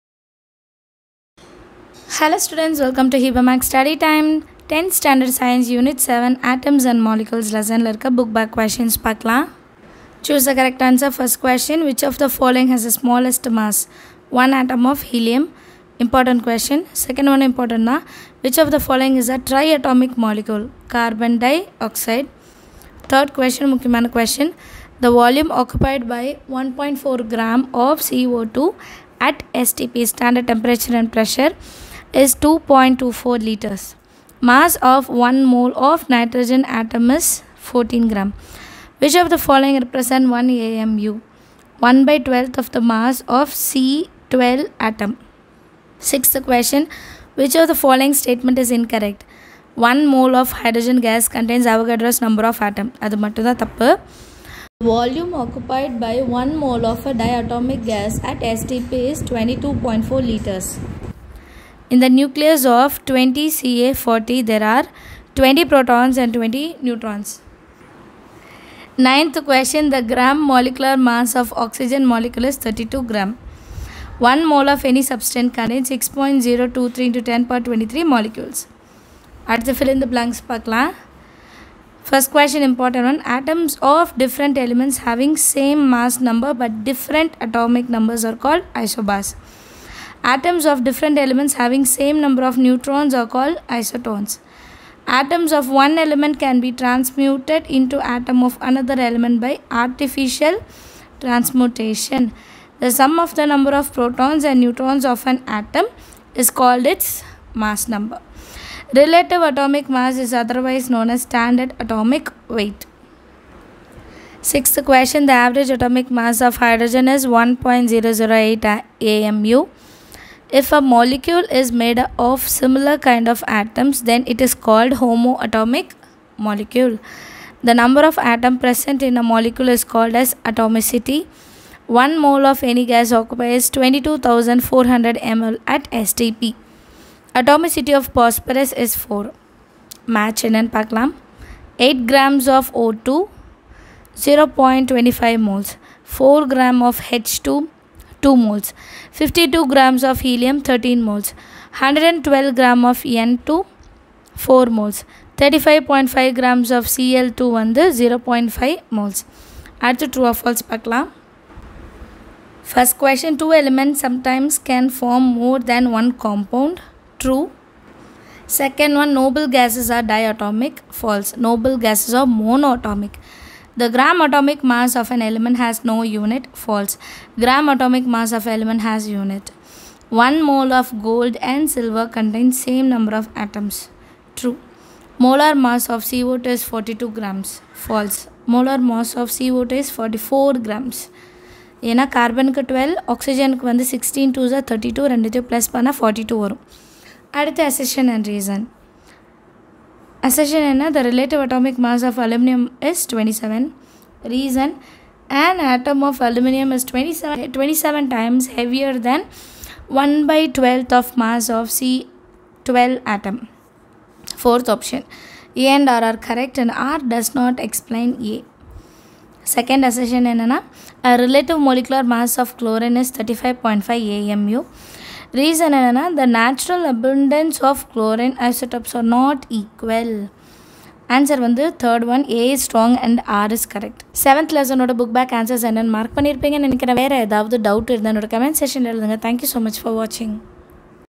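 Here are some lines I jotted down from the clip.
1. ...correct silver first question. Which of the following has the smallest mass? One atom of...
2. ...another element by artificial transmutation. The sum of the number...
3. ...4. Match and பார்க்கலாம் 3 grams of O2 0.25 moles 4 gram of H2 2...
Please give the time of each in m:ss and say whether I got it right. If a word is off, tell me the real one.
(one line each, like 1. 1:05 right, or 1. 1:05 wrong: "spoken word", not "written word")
1. 0:10 wrong: "answer", not "silver"
2. 1:38 right
3. 2:19 wrong: "8", not "3".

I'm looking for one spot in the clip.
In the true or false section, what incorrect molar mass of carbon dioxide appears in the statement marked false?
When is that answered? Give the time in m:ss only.
3:06.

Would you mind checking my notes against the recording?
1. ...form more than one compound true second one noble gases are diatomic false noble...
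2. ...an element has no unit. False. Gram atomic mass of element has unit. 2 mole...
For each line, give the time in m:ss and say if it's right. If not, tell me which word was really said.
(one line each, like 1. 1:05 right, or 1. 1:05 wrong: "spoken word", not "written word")
1. 2:44 right
2. 2:55 wrong: "1", not "2".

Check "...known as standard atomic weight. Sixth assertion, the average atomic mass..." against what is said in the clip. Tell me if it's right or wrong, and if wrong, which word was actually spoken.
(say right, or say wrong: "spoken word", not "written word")
wrong: "question", not "assertion".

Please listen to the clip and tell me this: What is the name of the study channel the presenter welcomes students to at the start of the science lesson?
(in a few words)
Hiba maths Study Time.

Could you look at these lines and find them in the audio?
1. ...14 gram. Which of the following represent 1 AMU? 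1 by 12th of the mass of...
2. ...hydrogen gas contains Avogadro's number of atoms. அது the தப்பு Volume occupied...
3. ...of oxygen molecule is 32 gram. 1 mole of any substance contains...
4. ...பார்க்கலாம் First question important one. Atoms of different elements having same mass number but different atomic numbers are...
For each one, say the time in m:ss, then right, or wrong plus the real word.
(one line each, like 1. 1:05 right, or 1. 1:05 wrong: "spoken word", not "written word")
1. 0:37 right
2. 0:50 right
3. 1:11 right
4. 1:20 right.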